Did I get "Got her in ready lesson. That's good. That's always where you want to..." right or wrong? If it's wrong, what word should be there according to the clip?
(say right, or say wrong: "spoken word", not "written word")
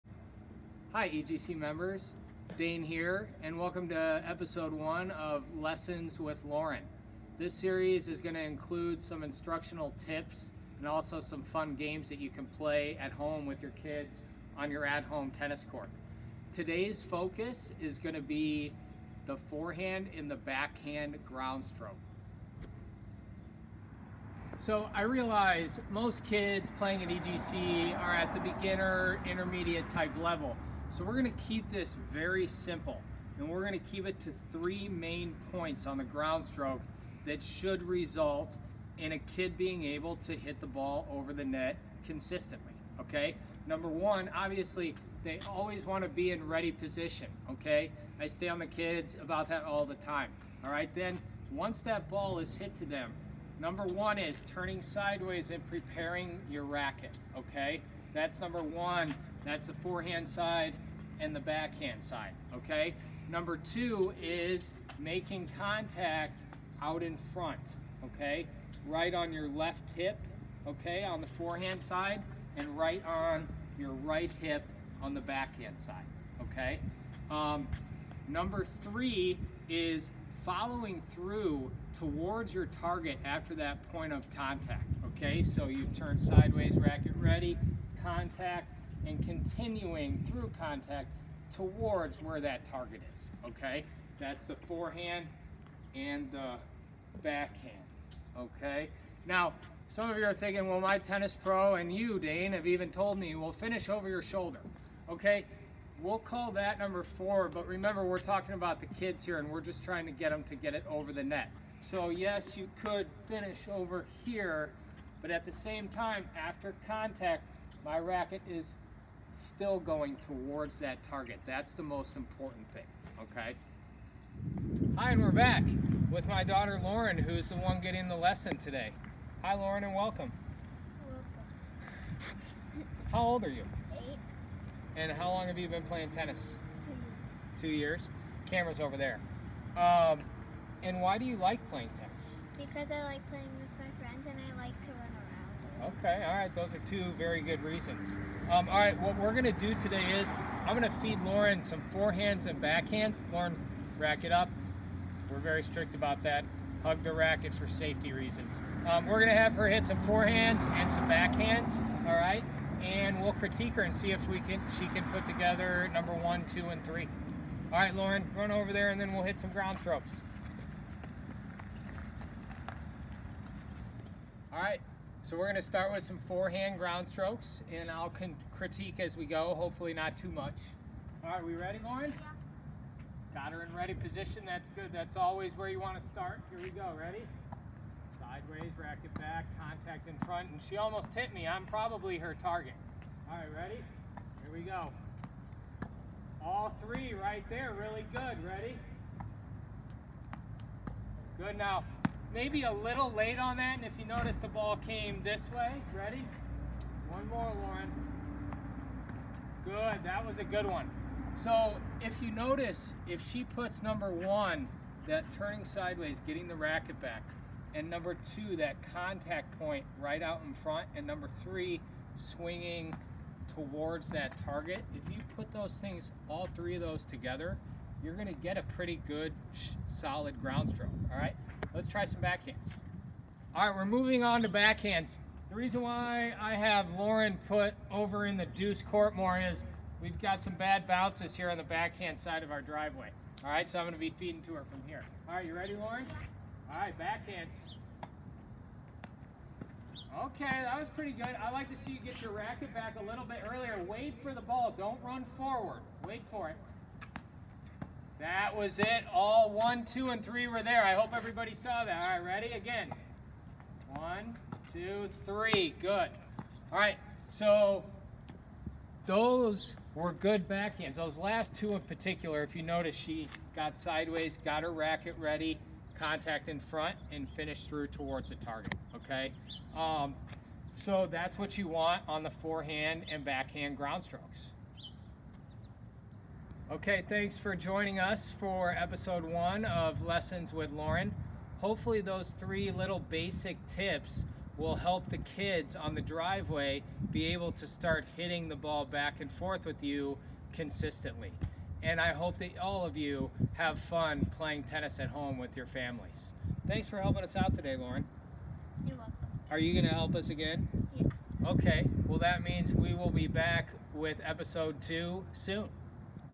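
wrong: "position", not "lesson".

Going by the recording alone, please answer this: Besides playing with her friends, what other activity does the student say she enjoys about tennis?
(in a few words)
to run.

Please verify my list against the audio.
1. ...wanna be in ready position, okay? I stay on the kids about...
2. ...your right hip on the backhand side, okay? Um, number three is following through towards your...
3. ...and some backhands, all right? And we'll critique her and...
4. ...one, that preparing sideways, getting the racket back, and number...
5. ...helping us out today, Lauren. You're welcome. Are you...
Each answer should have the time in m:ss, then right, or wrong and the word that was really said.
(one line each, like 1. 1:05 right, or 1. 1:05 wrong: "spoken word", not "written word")
1. 0:45 right
2. 1:13 right
3. 2:40 right
4. 3:34 wrong: "turning", not "preparing"
5. 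5:07 right.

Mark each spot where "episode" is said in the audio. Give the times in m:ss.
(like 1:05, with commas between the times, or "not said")
0:04, 4:48, 5:14.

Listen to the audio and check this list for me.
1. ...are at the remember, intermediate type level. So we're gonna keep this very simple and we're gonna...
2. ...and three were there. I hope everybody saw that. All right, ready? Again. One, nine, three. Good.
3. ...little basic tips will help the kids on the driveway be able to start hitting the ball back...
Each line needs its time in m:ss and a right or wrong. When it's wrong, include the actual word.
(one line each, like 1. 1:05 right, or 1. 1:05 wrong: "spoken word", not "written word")
1. 0:27 wrong: "beginner", not "remember"
2. 4:20 wrong: "two", not "nine"
3. 4:52 right.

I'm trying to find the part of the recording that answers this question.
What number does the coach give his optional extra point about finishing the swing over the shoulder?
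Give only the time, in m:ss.
1:46.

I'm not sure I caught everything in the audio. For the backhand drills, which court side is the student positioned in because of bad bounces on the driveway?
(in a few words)
deuce court.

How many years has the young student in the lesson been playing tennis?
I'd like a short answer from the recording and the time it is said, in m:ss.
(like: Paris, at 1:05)
2, at 2:17.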